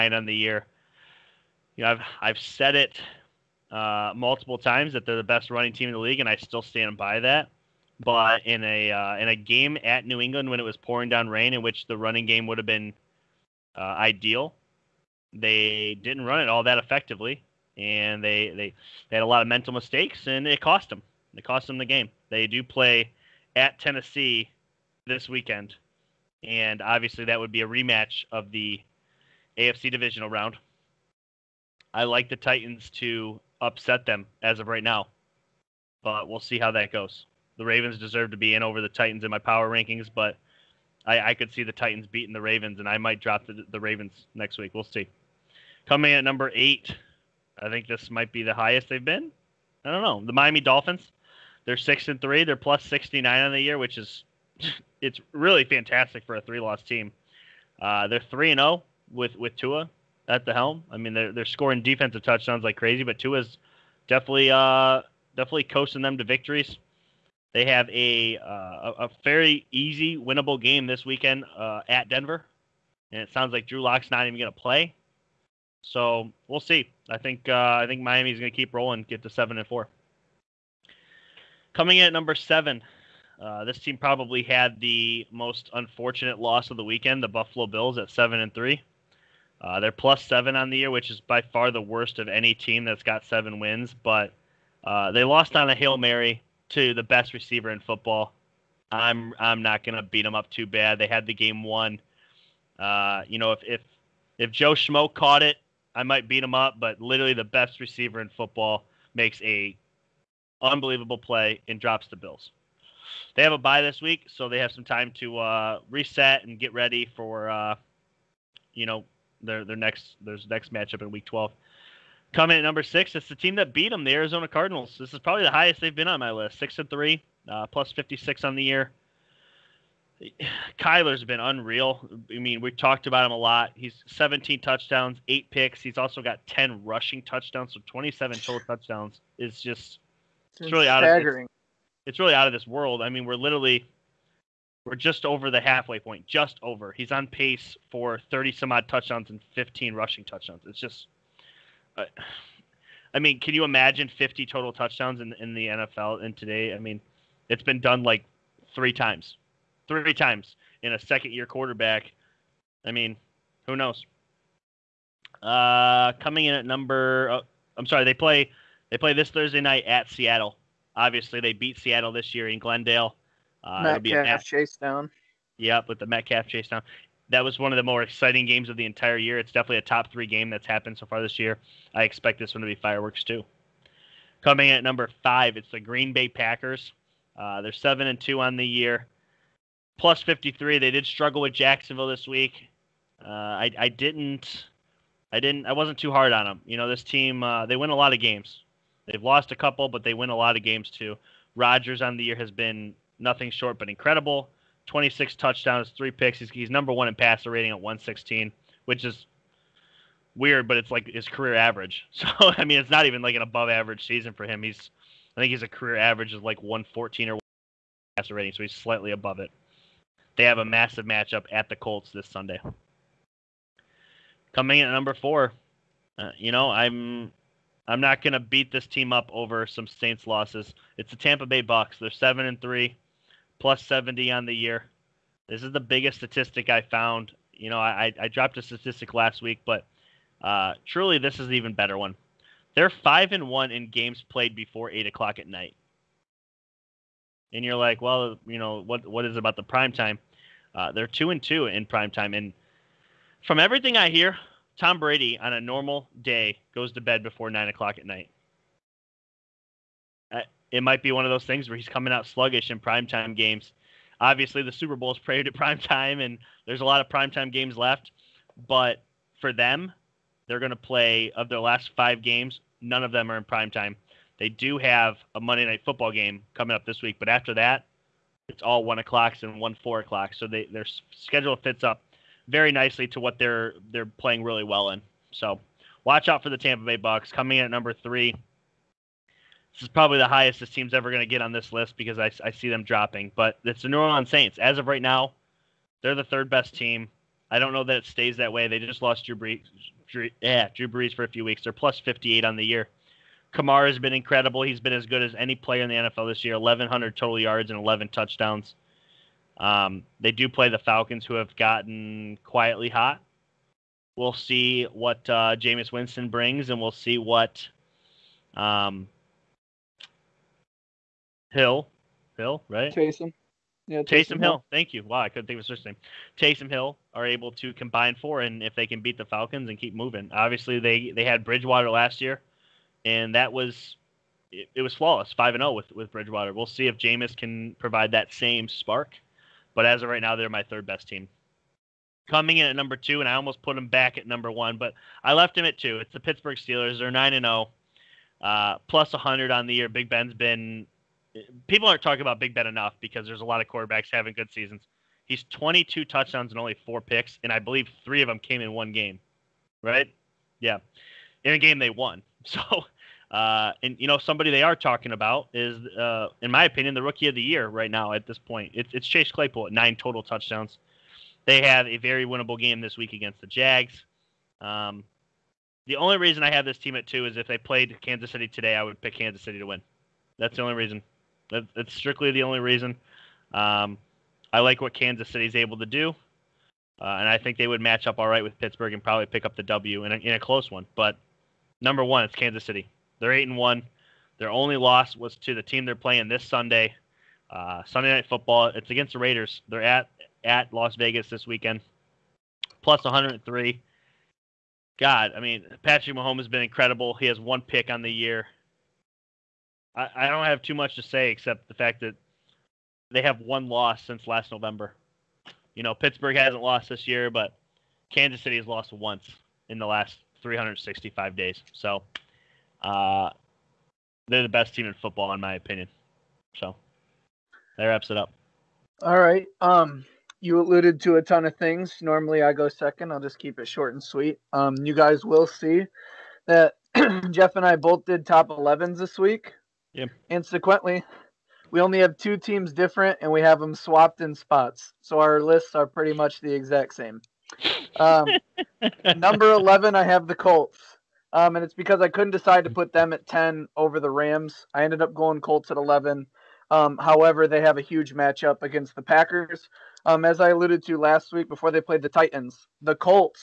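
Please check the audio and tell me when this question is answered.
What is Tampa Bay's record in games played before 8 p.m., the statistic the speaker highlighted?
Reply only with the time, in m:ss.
4:02.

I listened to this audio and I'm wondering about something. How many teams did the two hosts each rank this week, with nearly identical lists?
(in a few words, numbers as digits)
11.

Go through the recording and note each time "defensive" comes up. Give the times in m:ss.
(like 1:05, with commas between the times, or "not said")
1:01.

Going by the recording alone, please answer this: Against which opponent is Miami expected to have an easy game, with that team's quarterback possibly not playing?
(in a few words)
Denver.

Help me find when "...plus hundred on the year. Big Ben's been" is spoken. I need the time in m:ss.
5:48.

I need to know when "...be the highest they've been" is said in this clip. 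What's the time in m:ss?
0:48.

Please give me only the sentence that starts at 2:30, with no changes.
It's just, uh, I mean, can you imagine 50 total touchdowns in, in the NFL in today?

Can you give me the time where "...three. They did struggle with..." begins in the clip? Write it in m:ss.
3:10.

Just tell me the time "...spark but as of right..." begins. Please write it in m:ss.
5:38.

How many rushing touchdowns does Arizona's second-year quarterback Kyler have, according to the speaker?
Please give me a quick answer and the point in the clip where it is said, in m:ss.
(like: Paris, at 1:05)
10, at 2:16.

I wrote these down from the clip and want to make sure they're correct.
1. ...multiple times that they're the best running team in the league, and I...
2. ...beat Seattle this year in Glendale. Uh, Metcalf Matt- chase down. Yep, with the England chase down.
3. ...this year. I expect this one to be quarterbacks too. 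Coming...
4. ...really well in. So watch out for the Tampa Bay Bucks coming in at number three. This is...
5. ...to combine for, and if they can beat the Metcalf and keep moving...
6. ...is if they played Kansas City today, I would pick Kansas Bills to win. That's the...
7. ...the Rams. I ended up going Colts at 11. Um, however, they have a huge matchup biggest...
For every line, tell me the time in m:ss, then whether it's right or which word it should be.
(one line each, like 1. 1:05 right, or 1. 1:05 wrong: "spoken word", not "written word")
1. 0:04 right
2. 2:51 wrong: "Metcalf", not "England"
3. 3:01 wrong: "fireworks", not "quarterbacks"
4. 4:44 right
5. 5:27 wrong: "Falcons", not "Metcalf"
6. 6:17 wrong: "City", not "Bills"
7. 7:33 wrong: "against", not "biggest".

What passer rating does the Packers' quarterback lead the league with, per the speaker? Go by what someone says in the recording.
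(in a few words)
116.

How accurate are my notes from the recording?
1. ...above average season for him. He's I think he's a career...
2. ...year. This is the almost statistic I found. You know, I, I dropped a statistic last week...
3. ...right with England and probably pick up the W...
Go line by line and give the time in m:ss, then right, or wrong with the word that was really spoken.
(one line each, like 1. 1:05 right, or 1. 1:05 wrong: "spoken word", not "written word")
1. 3:33 right
2. 3:54 wrong: "biggest", not "almost"
3. 6:28 wrong: "Pittsburgh", not "England".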